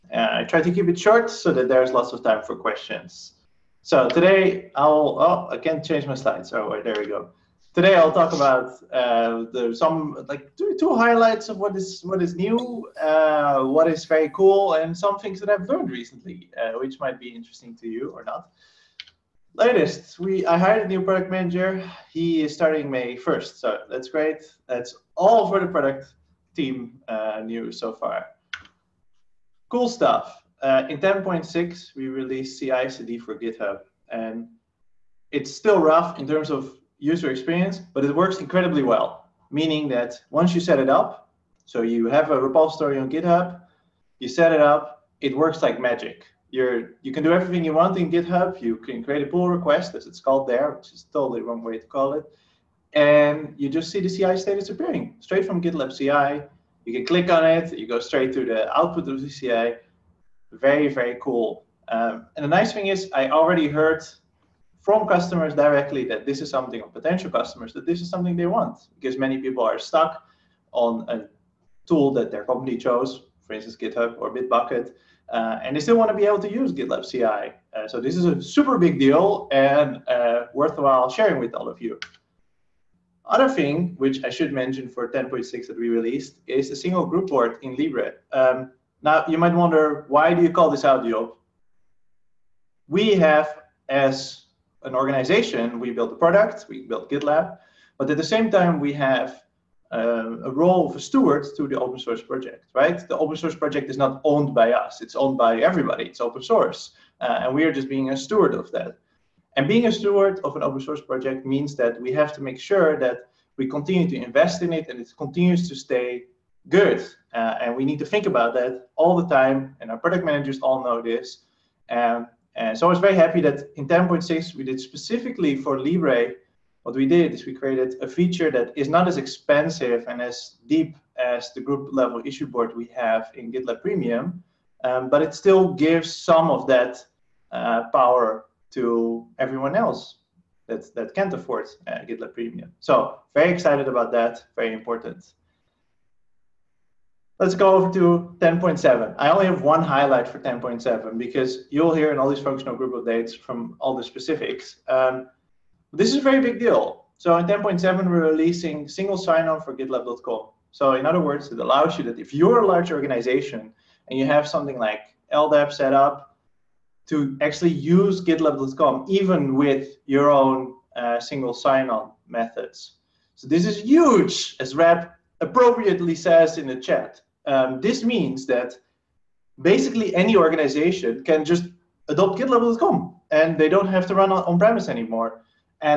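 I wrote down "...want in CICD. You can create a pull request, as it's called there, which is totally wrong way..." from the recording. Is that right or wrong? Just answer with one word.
wrong.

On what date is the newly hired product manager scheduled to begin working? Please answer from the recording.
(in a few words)
May 1st.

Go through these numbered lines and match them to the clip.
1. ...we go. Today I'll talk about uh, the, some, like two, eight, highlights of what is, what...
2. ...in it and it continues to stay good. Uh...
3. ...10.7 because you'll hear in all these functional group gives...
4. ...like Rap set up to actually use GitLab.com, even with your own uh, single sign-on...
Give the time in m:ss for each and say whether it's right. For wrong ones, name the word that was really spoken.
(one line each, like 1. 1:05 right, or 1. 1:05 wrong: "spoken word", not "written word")
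1. 0:06 wrong: "two", not "eight"
2. 1:54 right
3. 2:30 wrong: "updates", not "gives"
4. 2:44 wrong: "LDAP", not "Rap".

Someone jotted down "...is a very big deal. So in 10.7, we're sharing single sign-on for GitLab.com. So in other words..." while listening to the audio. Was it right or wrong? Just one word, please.
wrong.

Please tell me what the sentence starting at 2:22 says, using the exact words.
So very excited about that, very important.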